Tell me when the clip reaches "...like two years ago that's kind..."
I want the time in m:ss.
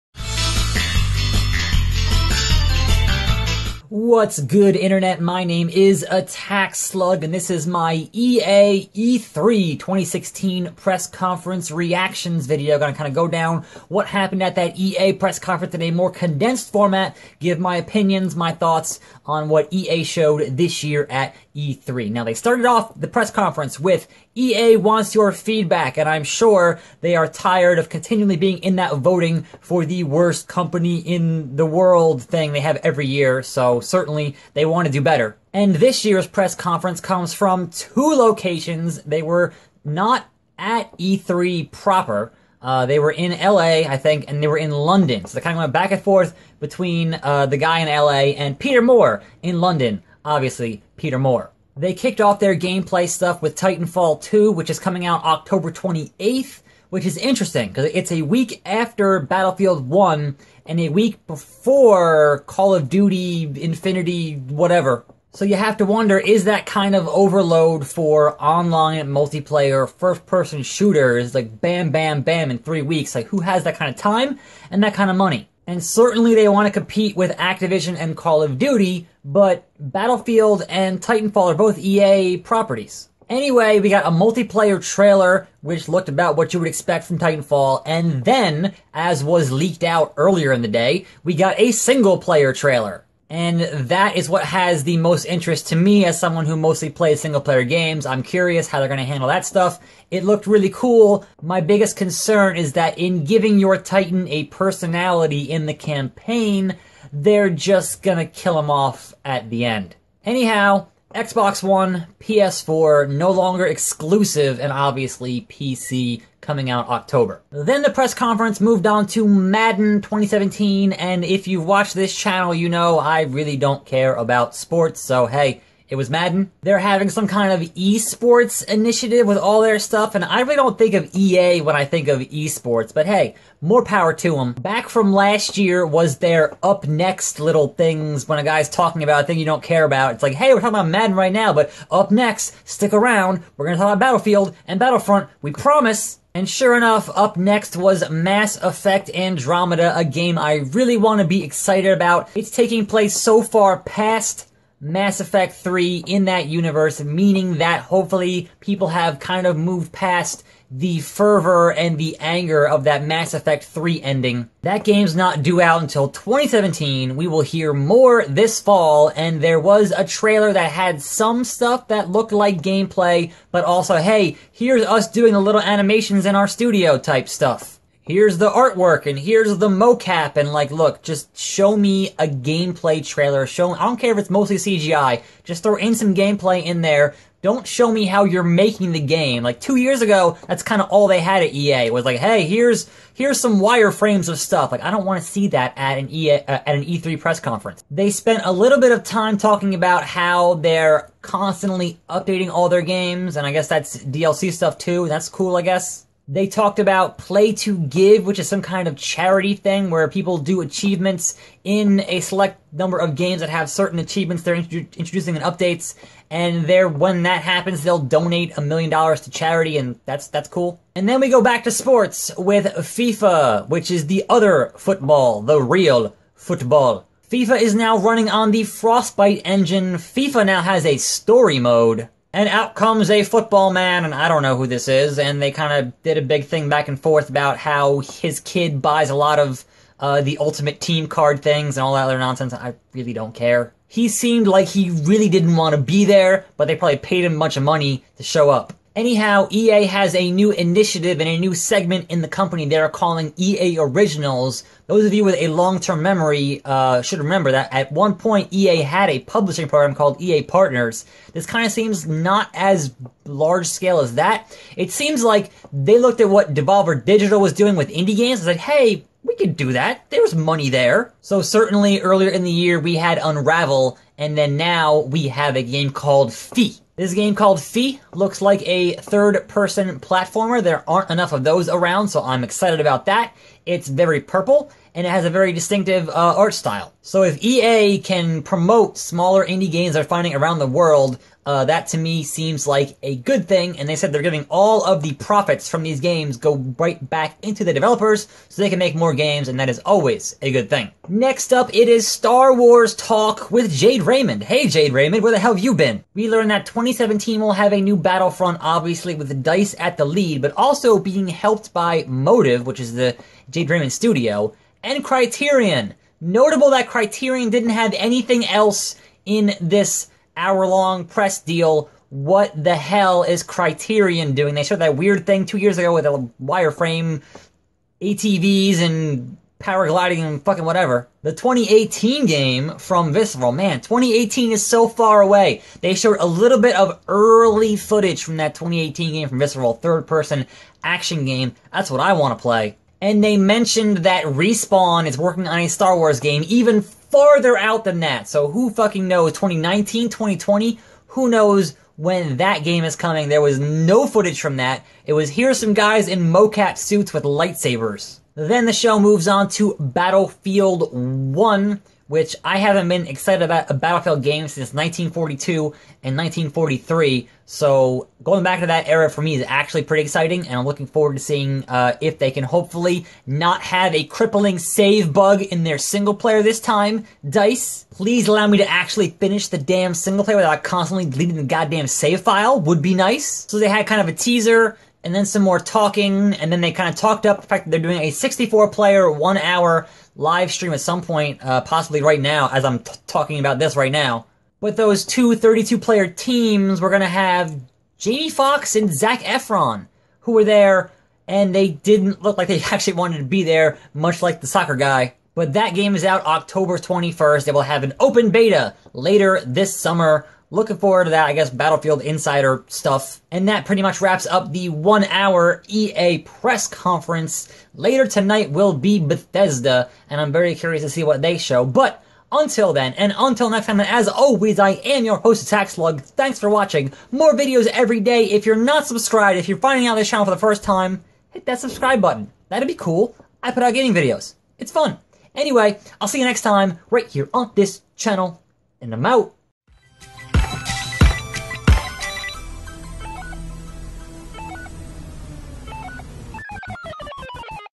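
3:09.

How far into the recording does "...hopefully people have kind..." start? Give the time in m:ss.
2:37.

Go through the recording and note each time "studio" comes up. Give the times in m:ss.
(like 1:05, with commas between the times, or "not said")
2:56, 5:13.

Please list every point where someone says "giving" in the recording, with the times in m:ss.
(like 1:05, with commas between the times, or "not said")
1:43, 4:54.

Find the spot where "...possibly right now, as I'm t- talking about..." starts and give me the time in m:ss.
6:31.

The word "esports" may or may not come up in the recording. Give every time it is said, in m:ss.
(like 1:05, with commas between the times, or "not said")
2:07, 2:12.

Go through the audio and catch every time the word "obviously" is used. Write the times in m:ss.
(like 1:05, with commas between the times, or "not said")
0:50, 1:54, 5:08.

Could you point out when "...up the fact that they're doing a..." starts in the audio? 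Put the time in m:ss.
6:27.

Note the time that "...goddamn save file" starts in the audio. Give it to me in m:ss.
6:21.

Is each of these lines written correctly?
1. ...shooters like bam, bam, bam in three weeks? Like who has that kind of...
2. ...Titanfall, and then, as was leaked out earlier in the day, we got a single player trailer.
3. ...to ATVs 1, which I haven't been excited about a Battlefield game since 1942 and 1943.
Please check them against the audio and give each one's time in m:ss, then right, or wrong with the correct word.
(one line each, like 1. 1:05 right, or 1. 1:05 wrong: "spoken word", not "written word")
1. 1:10 right
2. 1:27 right
3. 5:59 wrong: "Battlefield", not "ATVs".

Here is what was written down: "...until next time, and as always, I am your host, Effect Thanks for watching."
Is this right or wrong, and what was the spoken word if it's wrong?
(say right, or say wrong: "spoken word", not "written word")
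wrong: "Attack", not "Effect".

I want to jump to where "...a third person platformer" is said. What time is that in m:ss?
4:38.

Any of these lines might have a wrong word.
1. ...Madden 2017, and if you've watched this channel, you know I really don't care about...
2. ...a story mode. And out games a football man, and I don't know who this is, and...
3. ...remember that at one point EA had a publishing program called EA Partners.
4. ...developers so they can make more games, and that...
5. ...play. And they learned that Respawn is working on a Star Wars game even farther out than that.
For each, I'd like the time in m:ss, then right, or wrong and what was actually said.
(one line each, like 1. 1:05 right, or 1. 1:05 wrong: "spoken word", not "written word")
1. 1:59 right
2. 3:50 wrong: "comes", not "games"
3. 4:17 right
4. 4:57 right
5. 5:42 wrong: "mentioned", not "learned".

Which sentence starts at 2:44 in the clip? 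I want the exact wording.
That game's not due out until 2017.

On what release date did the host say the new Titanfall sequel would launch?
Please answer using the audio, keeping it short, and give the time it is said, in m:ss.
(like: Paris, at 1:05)
October 28th, at 0:55.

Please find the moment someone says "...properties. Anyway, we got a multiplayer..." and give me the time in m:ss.
1:22.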